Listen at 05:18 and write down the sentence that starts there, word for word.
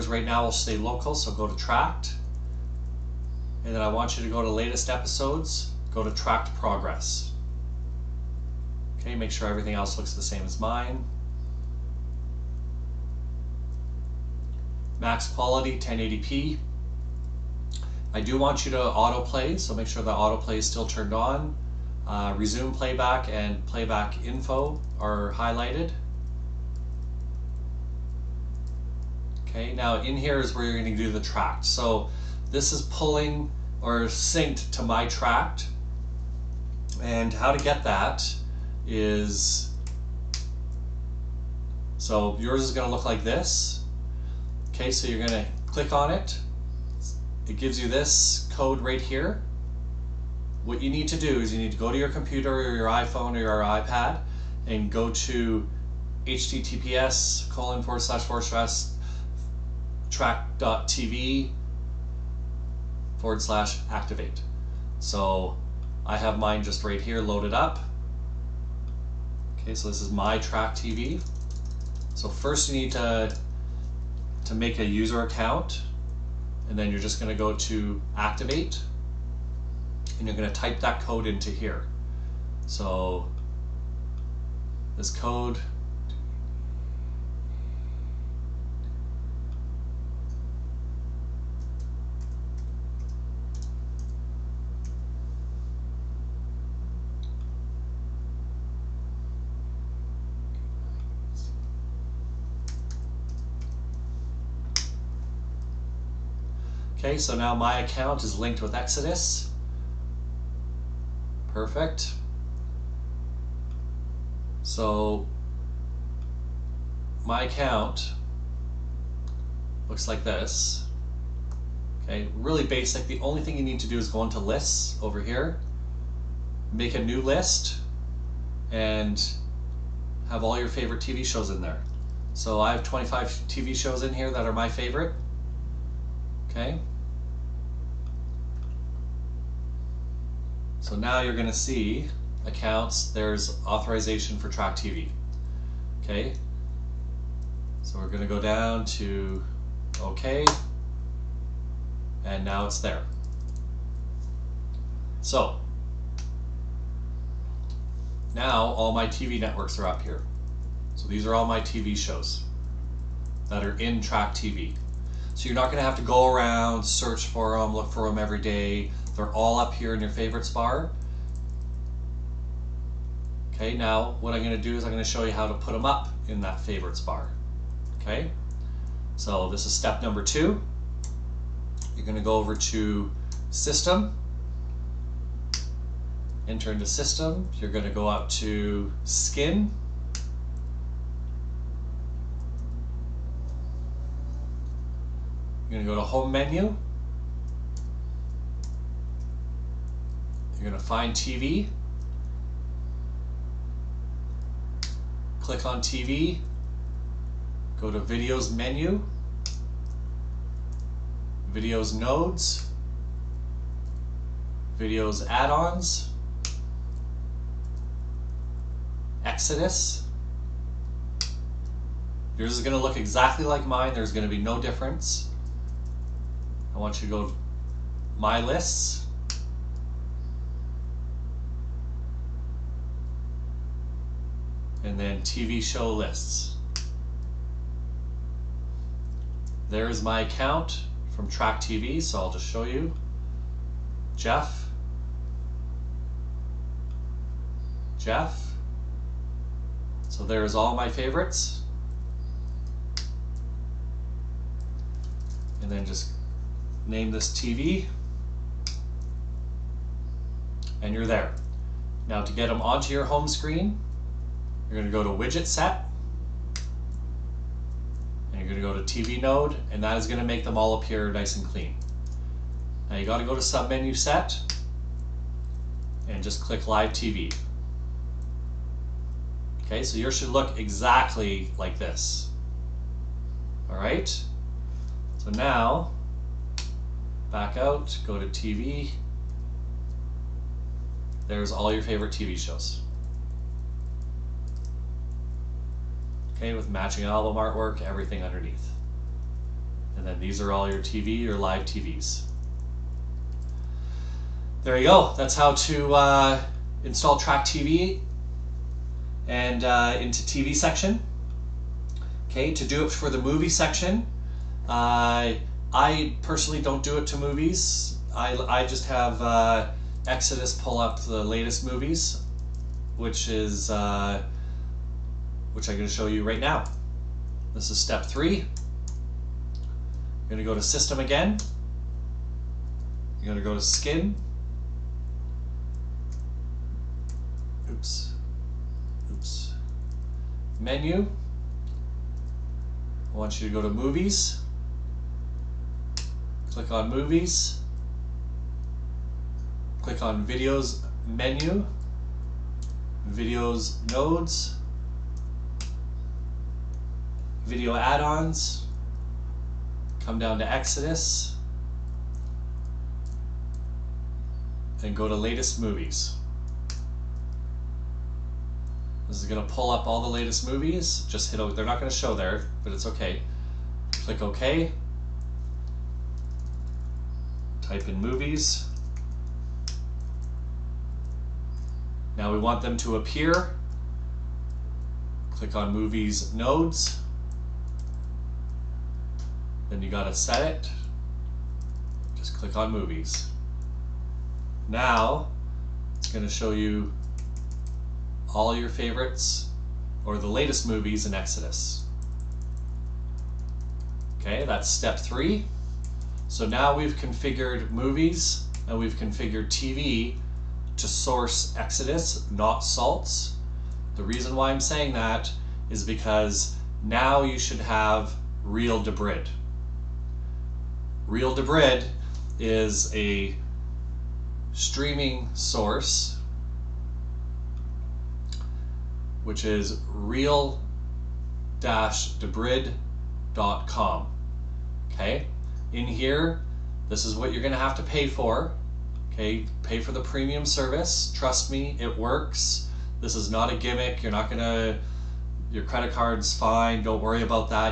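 I, I just have uh, Exodus pull up the latest movies, which is uh, which I'm going to show you right now.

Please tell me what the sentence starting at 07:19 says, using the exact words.
Okay, pay for the premium service.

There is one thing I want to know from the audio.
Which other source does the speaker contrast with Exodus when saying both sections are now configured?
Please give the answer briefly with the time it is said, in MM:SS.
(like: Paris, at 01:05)
Salts, at 06:52.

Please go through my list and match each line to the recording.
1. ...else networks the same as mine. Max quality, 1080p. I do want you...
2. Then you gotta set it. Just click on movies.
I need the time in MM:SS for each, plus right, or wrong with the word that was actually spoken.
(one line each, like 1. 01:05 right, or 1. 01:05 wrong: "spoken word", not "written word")
1. 00:09 wrong: "looks", not "networks"
2. 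06:29 right.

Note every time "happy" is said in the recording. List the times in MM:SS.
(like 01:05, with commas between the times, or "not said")
not said.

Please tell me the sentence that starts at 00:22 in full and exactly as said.
Uh, resume playback and playback info are highlighted.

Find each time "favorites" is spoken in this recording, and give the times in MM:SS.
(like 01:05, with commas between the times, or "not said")
02:10, 02:14, 02:50, 02:56, 04:10, 04:51, 06:38.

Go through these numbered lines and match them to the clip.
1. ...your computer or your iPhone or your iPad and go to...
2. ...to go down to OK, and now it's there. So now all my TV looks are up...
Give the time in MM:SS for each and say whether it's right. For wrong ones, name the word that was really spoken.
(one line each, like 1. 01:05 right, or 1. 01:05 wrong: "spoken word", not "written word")
1. 00:51 right
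2. 02:28 wrong: "networks", not "looks".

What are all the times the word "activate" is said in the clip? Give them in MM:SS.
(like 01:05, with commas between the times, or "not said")
01:03, 01:18.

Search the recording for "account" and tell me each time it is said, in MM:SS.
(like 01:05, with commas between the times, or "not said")
01:15, 01:47, 01:57, 02:22, 04:00.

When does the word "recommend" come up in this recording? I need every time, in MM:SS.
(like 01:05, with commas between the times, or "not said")
not said.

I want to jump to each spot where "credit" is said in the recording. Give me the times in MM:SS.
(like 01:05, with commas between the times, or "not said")
07:25.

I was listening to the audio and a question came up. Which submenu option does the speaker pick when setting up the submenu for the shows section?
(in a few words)
Live TV.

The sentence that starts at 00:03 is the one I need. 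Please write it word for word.
And then I want you to go to latest episodes, go to Trakt progress.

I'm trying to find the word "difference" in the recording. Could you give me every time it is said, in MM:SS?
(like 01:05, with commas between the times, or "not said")
03:44.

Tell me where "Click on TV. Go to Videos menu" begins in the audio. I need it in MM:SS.
03:25.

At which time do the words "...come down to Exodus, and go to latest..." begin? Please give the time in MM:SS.
06:00.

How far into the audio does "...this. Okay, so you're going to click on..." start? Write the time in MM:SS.
00:43.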